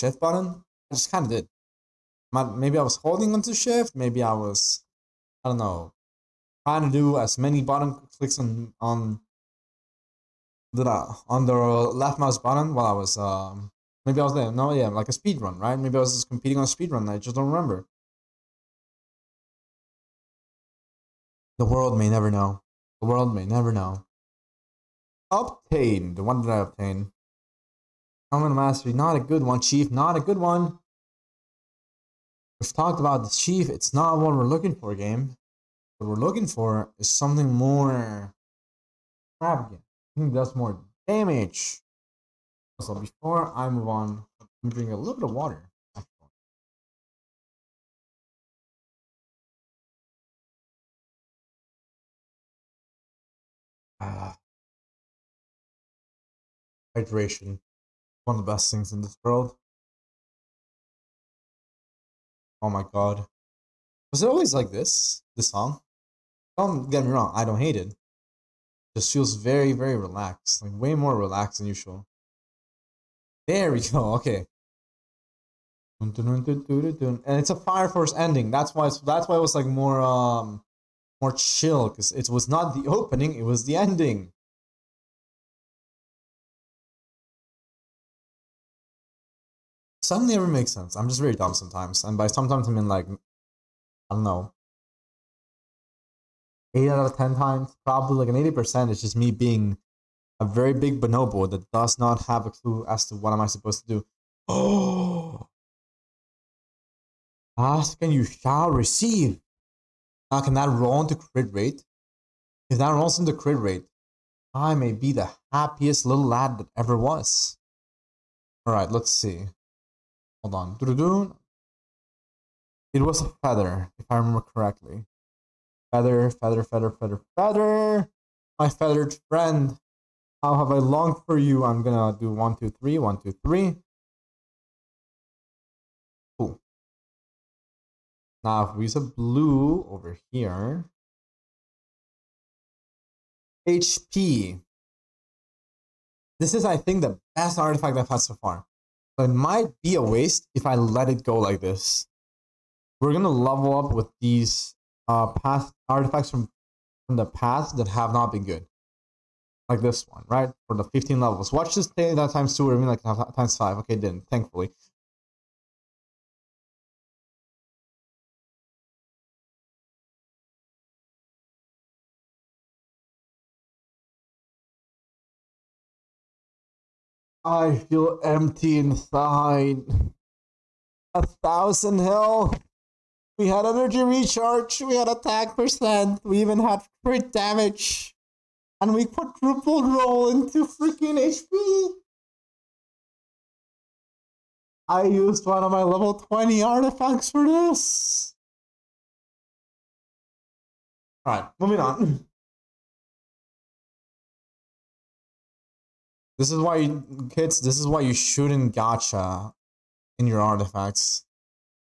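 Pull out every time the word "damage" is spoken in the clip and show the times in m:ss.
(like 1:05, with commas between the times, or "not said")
0:41, 3:07.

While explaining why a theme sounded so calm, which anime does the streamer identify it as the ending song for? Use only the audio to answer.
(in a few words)
Fire Force.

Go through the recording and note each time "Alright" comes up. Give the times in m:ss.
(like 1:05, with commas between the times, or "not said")
1:58, 3:21.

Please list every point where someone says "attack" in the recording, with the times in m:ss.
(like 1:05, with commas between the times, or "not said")
3:05.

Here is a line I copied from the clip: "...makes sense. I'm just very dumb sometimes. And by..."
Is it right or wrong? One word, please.
right.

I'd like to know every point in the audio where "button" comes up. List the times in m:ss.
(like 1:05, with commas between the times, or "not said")
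0:00, 0:07, 0:12.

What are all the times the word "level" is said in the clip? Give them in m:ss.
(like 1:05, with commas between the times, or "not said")
2:33, 2:41, 3:15.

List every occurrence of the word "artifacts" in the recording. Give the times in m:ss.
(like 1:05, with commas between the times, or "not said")
2:27, 2:35, 3:16, 3:30.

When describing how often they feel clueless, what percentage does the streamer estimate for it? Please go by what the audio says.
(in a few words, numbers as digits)
80%.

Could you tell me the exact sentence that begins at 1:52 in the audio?
If that rolls into crit rate, I may be the happiest little lad that ever was.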